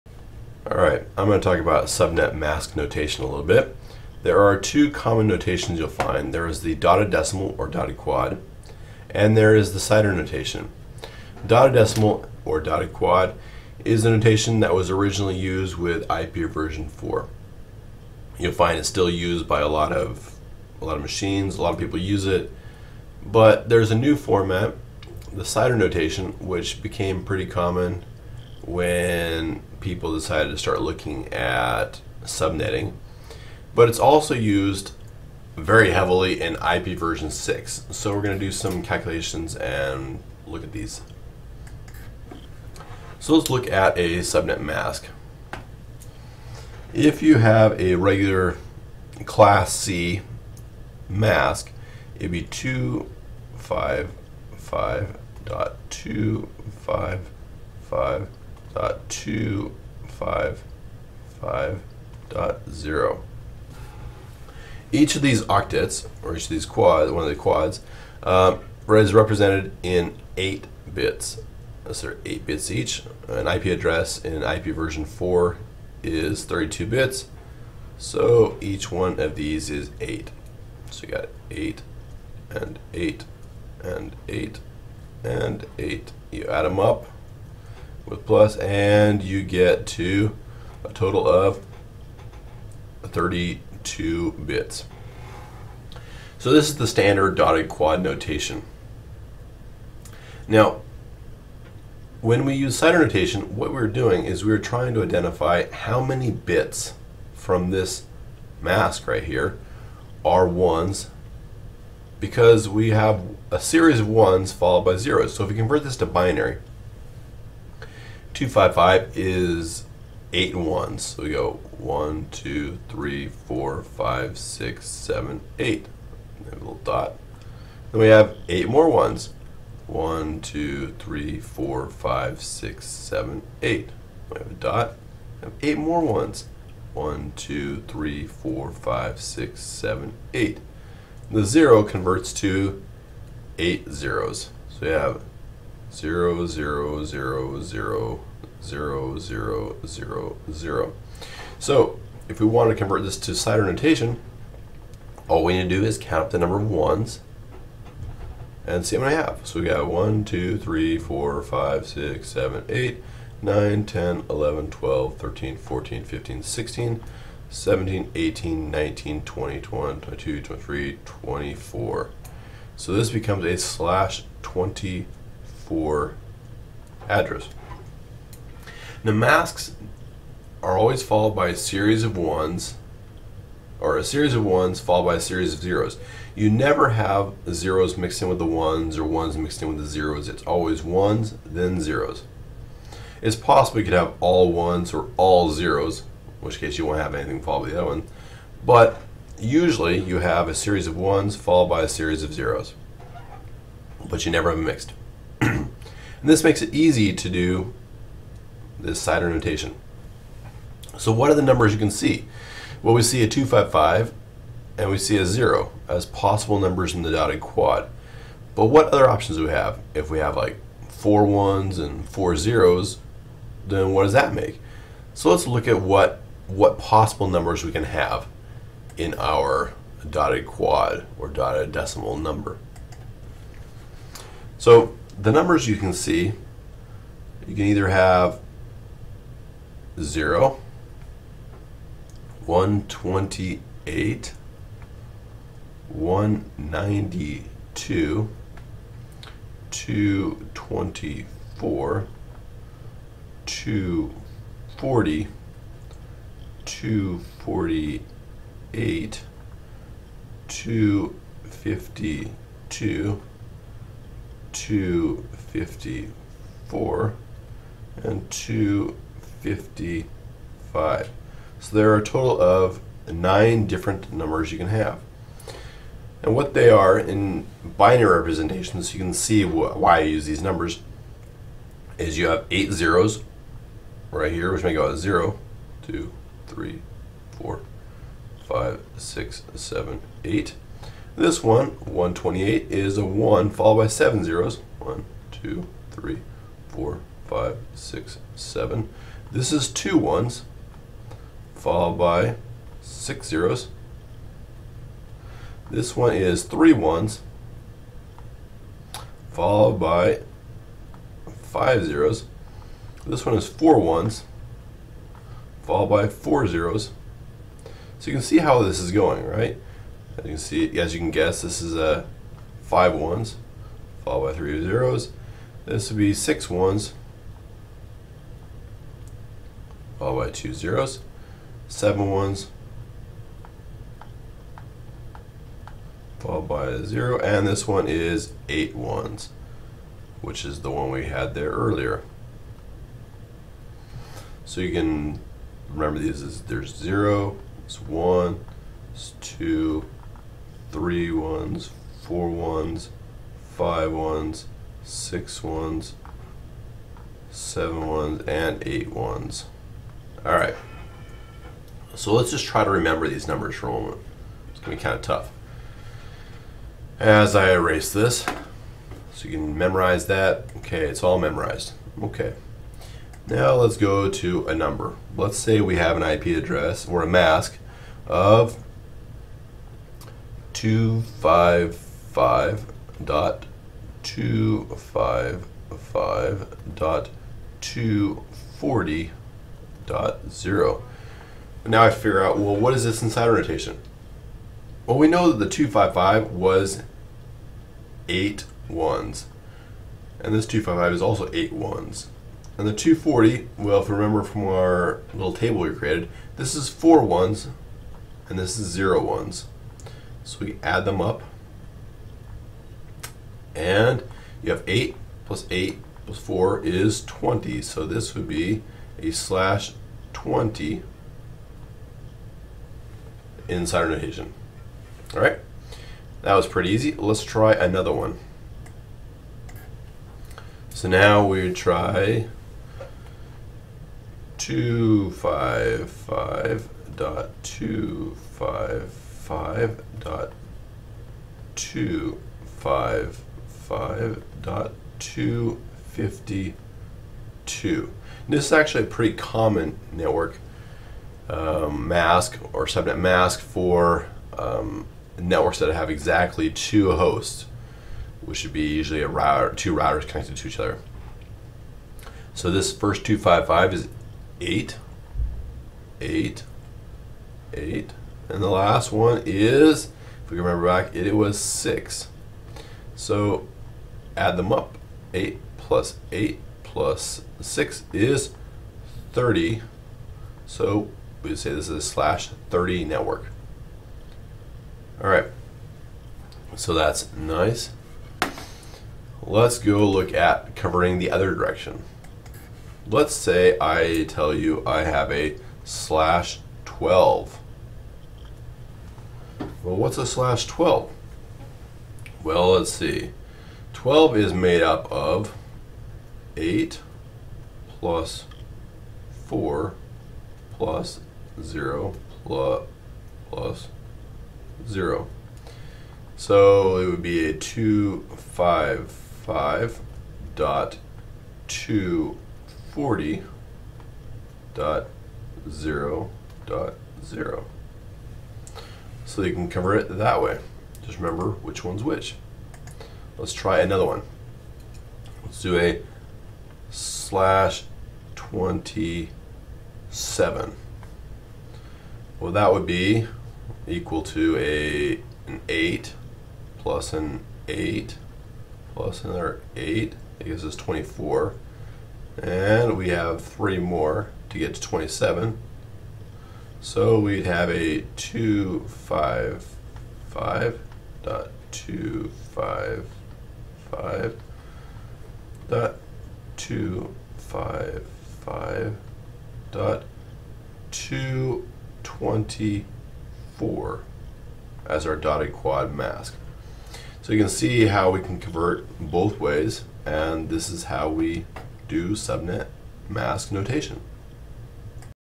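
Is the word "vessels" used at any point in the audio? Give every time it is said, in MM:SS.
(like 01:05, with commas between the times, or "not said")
not said.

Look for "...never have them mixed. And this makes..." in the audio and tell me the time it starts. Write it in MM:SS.
03:24.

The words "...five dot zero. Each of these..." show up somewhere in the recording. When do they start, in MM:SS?
01:01.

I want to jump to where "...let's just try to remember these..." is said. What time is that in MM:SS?
06:02.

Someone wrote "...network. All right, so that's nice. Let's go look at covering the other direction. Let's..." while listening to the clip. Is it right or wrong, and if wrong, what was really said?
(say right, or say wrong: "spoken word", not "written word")
right.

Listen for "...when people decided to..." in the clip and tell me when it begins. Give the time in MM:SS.
00:28.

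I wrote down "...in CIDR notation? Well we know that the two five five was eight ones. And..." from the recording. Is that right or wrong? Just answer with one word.
right.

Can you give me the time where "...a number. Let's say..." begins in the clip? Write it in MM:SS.
06:14.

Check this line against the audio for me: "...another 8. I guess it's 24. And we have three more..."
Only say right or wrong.
right.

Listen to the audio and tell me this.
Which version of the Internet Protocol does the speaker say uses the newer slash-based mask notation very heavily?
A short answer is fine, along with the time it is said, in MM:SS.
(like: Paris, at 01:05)
IP version 6, at 00:36.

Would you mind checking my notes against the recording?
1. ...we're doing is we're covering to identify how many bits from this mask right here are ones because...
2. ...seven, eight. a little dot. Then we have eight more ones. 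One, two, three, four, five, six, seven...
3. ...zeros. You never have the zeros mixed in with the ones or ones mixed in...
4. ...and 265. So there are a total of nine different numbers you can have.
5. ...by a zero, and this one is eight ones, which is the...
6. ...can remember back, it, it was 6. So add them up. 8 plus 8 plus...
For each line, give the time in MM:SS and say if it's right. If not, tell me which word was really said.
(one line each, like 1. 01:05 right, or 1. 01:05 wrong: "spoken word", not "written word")
1. 01:43 wrong: "trying", not "covering"
2. 02:04 right
3. 03:05 right
4. 04:28 wrong: "255", not "265"
5. 05:36 right
6. 07:50 right.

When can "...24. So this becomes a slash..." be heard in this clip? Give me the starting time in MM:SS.
02:51.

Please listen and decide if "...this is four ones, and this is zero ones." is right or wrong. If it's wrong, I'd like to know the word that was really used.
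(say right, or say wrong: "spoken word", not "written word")
right.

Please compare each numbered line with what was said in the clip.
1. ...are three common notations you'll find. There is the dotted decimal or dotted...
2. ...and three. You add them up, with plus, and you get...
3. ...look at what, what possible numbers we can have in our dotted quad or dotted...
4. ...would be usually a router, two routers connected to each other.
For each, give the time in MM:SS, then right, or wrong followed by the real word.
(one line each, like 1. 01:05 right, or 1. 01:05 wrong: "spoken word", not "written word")
1. 00:04 wrong: "two", not "three"
2. 01:25 wrong: "eight", not "three"
3. 03:45 right
4. 07:38 right.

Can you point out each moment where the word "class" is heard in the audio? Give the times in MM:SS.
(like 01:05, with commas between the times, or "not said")
00:49.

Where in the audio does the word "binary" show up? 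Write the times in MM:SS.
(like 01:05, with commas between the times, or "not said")
01:56, 04:37.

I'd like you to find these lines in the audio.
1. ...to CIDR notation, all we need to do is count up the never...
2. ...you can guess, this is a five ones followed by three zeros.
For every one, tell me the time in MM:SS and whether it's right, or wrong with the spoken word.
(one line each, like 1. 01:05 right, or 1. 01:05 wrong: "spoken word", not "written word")
1. 02:33 wrong: "number", not "never"
2. 05:20 right.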